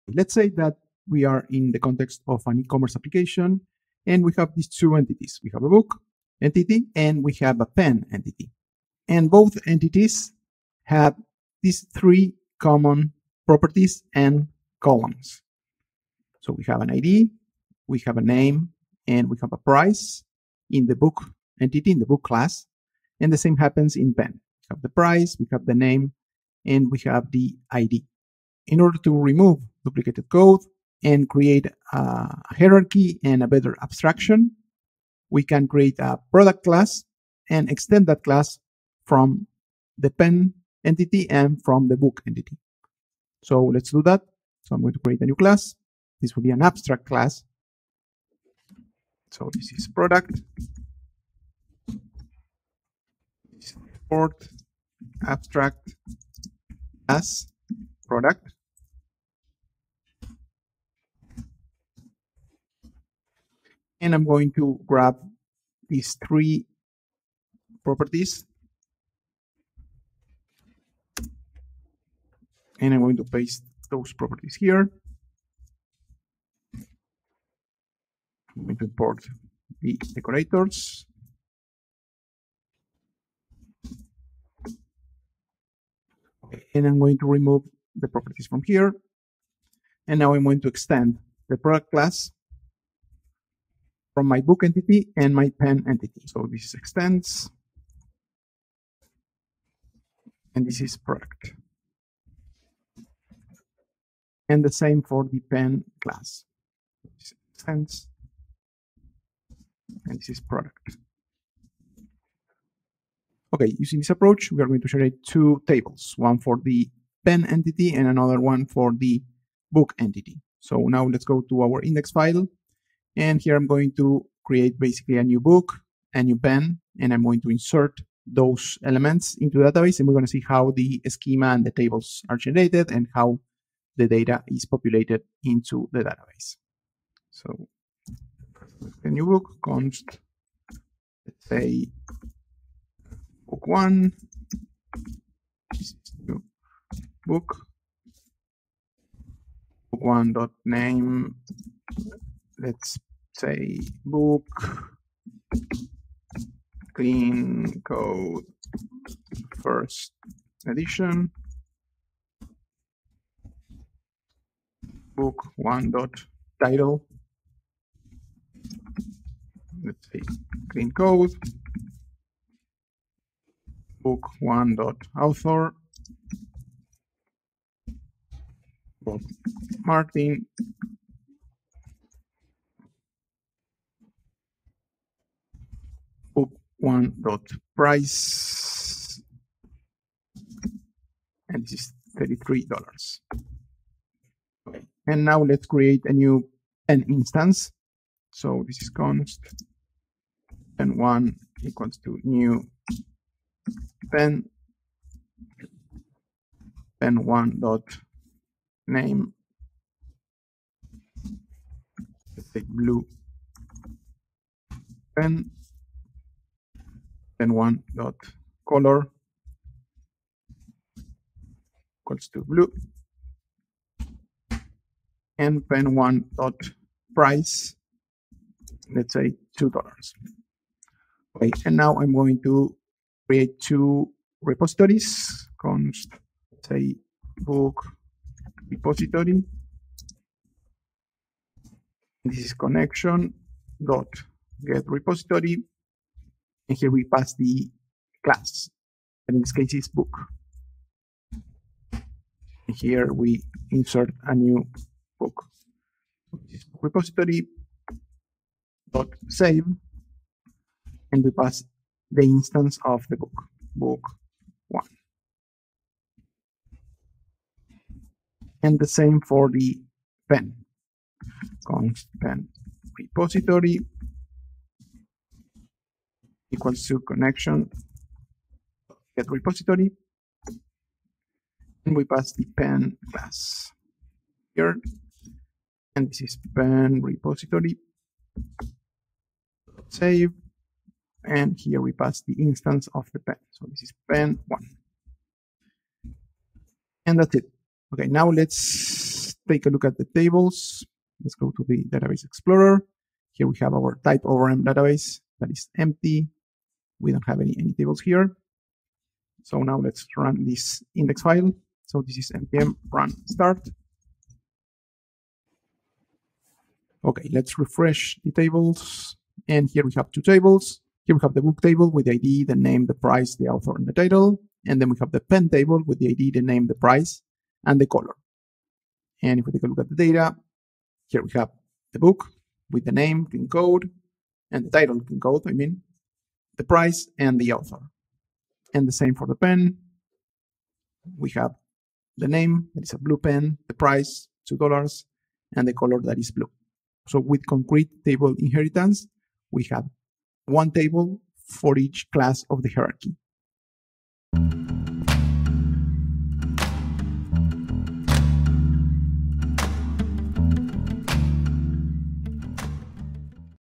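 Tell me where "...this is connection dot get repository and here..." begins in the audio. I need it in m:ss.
4:02.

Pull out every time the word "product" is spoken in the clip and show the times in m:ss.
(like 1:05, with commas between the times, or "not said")
0:36, 0:49, 0:58, 1:31, 1:40, 1:50.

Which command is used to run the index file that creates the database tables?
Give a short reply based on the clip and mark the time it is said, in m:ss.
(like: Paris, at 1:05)
npm run start, at 5:12.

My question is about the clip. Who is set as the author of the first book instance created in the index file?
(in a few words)
Bob Martin.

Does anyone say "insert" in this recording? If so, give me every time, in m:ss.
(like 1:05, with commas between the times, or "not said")
2:07, 4:13.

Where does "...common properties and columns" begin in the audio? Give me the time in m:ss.
0:12.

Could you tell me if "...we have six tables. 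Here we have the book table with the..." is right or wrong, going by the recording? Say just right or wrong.
wrong.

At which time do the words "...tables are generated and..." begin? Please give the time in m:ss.
2:11.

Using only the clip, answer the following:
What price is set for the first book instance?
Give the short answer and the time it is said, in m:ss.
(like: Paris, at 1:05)
$33, at 3:12.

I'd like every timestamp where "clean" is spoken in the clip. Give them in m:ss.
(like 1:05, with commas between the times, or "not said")
2:36, 2:50, 5:35.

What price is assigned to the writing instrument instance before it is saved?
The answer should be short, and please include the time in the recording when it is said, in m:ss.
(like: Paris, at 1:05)
$2, at 3:49.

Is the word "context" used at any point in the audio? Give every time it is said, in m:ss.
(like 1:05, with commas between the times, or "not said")
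0:01.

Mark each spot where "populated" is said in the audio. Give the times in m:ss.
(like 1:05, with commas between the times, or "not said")
2:14.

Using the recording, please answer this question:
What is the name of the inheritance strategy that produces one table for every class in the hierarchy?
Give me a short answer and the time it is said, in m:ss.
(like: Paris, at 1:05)
concrete table inheritance, at 5:47.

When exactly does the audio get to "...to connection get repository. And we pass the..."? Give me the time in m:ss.
4:36.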